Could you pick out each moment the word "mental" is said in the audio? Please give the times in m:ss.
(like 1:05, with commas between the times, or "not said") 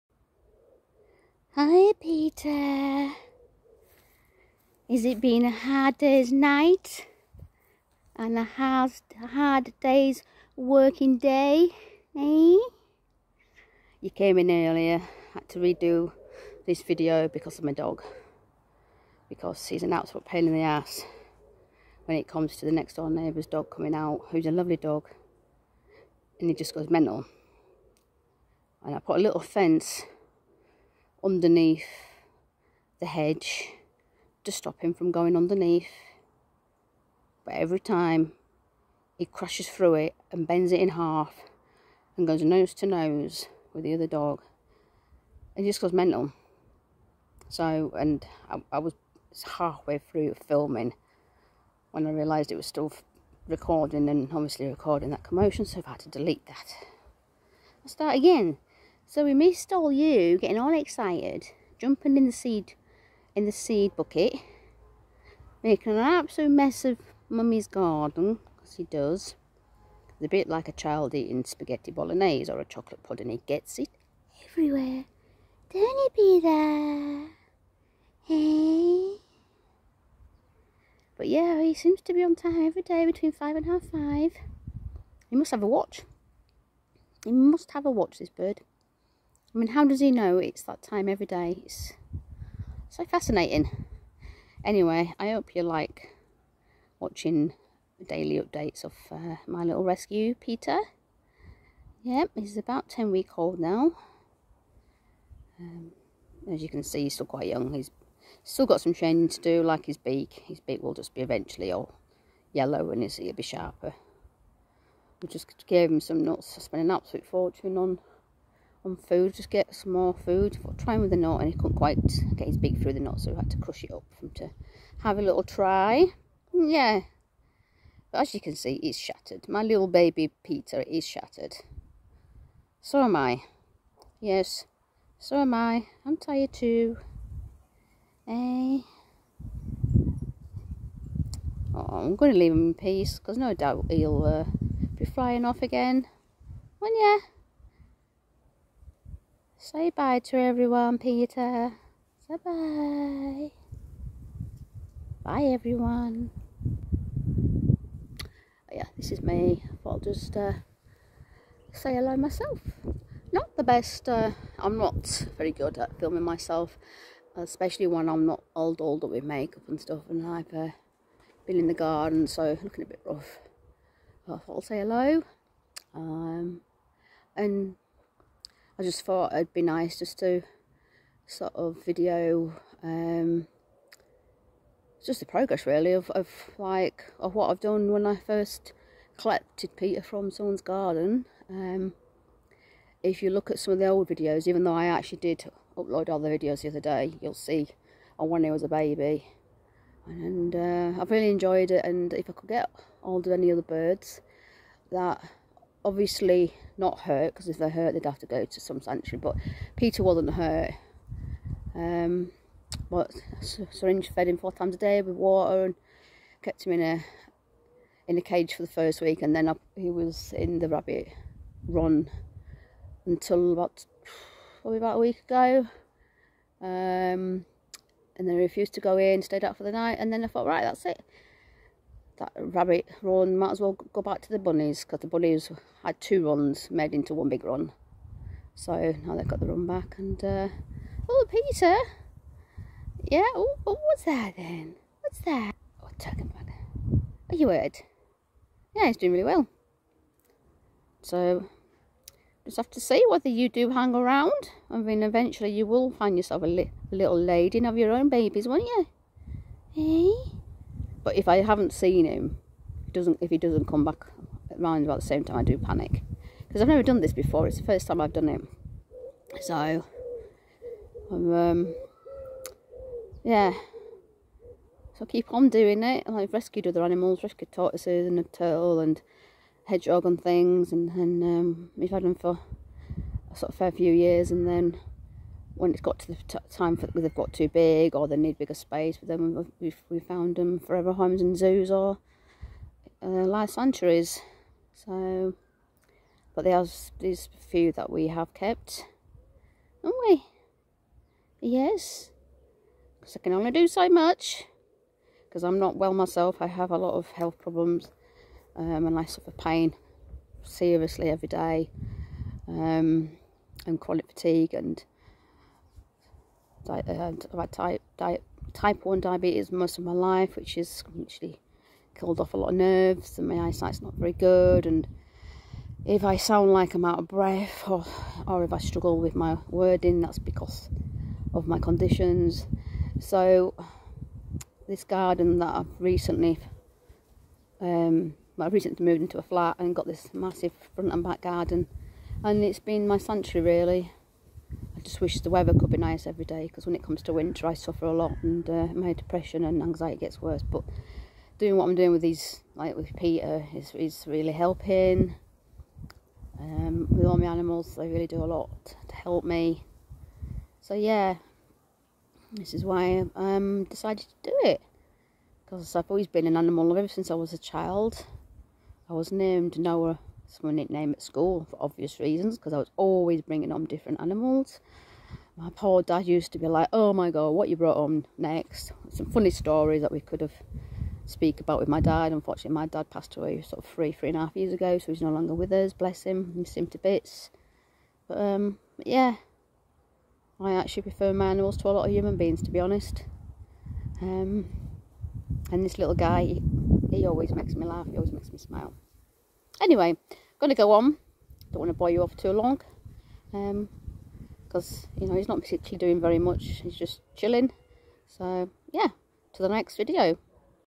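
0:26, 0:45.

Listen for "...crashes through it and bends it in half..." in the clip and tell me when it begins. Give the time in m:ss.
0:39.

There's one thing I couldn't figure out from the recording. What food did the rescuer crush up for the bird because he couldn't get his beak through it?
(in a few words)
Nuts.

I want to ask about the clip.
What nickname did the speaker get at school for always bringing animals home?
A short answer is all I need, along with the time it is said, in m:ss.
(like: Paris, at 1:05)
Noah, at 6:09.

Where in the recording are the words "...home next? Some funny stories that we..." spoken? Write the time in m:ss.
6:17.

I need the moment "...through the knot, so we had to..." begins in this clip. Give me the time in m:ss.
2:02.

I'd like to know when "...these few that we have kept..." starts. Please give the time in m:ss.
4:56.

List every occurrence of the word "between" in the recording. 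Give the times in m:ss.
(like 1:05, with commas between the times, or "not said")
1:23.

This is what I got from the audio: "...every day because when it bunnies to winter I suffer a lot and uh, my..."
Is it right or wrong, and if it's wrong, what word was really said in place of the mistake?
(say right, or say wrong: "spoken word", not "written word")
wrong: "comes", not "bunnies".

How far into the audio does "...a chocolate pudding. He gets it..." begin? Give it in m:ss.
1:12.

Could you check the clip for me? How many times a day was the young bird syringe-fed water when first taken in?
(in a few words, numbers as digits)
4.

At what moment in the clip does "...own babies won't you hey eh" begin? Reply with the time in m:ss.
4:17.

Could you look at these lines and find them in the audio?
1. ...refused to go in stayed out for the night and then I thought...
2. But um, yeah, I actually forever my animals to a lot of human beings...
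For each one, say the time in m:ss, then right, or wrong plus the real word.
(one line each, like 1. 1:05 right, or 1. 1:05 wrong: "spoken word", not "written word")
1. 3:48 right
2. 6:28 wrong: "prefer", not "forever".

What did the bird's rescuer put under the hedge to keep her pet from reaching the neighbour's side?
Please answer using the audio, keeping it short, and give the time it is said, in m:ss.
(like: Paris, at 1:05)
A little fence, at 0:29.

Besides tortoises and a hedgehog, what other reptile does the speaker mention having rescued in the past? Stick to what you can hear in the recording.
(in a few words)
A turtle.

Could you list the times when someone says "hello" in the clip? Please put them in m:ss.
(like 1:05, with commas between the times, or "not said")
2:41, 2:54.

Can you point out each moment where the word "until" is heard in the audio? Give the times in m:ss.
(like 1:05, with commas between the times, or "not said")
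3:43.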